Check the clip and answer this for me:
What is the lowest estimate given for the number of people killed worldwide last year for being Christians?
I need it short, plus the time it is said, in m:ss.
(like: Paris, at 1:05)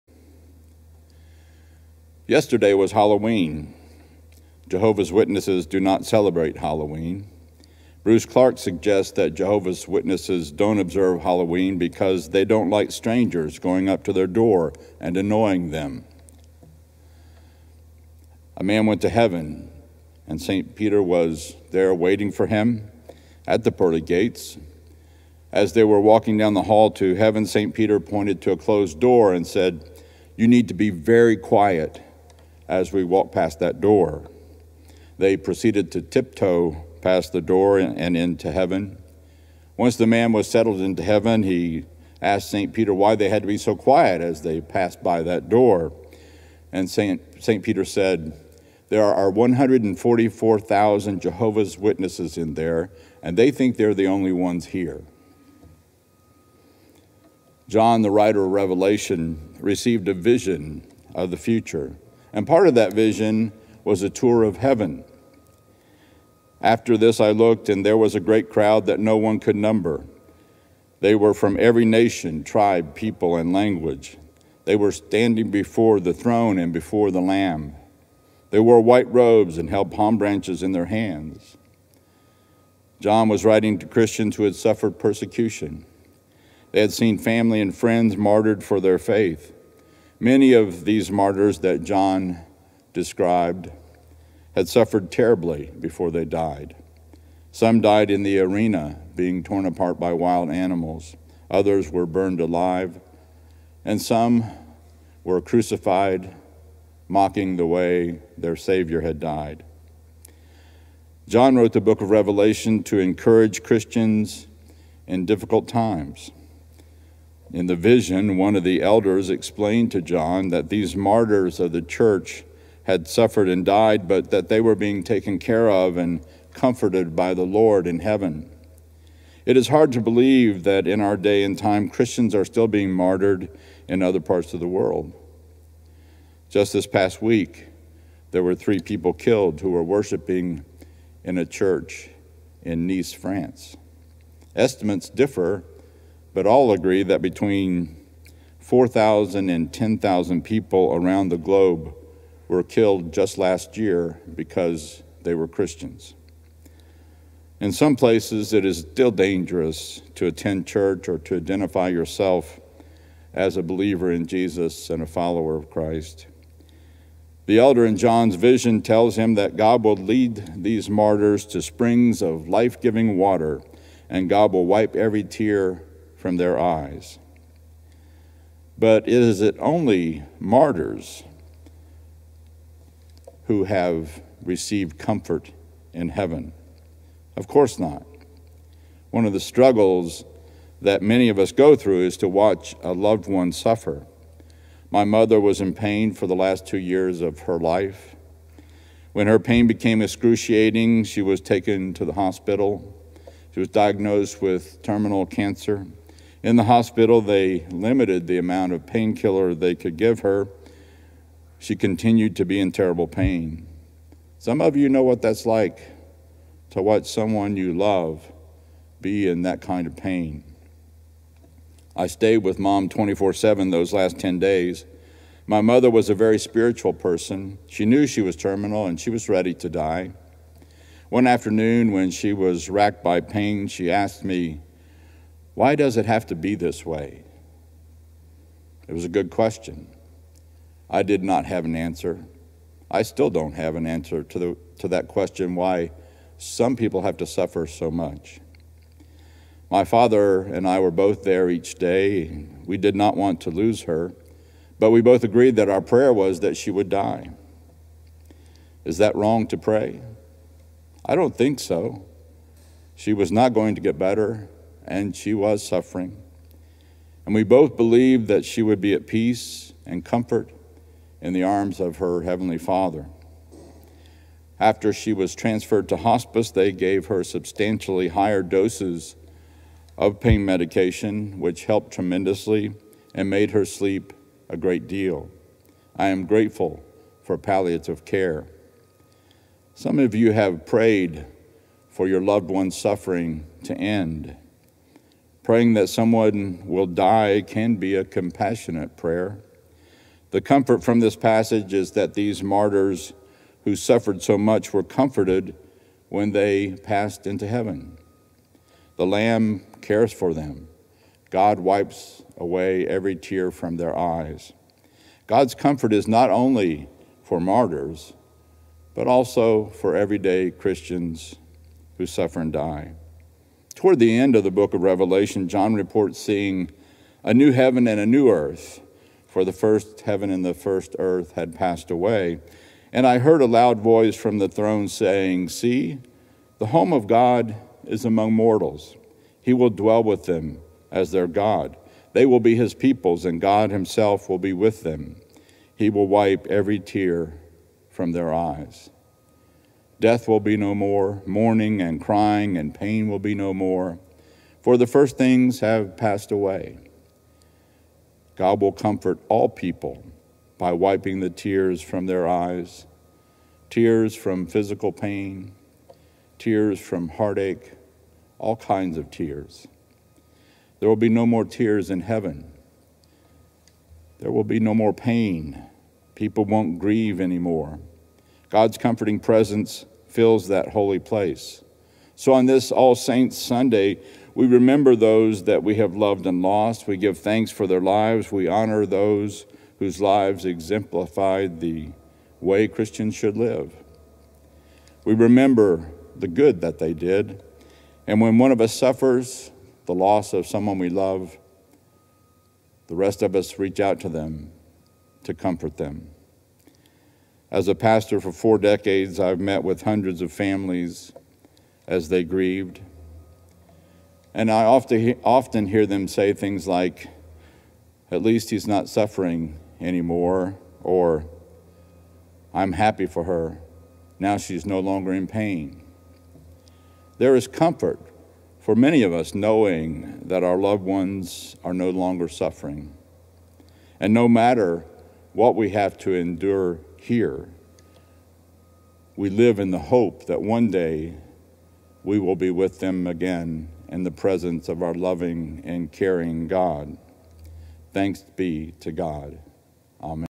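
4,000, at 2:28.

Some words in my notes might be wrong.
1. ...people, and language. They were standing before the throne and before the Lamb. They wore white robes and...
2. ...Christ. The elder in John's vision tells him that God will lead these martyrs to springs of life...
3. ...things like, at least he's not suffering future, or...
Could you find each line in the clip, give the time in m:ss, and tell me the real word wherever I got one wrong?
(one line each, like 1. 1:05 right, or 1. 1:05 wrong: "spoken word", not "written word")
1. 1:12 right
2. 2:45 right
3. 6:56 wrong: "anymore", not "future".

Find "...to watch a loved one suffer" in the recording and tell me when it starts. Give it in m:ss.
3:12.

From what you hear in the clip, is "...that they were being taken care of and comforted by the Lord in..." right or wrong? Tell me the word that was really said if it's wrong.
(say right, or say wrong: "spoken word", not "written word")
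right.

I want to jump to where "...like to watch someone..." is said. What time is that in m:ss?
3:35.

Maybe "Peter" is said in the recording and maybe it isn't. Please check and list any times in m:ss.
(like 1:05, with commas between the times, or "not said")
0:20, 0:27, 0:42, 0:47.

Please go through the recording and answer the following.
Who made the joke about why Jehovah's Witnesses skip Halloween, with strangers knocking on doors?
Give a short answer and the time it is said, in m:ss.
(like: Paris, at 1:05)
Bruce Clark, at 0:08.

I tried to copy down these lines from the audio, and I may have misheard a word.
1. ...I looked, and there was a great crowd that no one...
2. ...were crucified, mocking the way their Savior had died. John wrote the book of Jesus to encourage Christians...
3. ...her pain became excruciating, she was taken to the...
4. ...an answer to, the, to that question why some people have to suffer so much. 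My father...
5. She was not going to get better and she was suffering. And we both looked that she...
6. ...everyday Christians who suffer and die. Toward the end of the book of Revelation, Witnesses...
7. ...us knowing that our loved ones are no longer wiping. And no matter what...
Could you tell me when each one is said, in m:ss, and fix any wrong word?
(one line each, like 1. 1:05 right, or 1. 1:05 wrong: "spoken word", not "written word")
1. 1:07 right
2. 1:45 wrong: "Revelation", not "Jesus"
3. 3:19 right
4. 4:03 right
5. 4:22 wrong: "believed", not "looked"
6. 5:19 wrong: "John", not "Witnesses"
7. 7:09 wrong: "suffering", not "wiping".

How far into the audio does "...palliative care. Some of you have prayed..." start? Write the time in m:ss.
4:47.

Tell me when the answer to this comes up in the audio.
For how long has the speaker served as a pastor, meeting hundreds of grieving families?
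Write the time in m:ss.
6:48.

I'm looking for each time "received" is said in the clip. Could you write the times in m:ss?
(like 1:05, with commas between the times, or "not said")
0:59, 3:04.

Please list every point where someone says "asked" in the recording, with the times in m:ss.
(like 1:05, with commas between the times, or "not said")
0:42, 3:53.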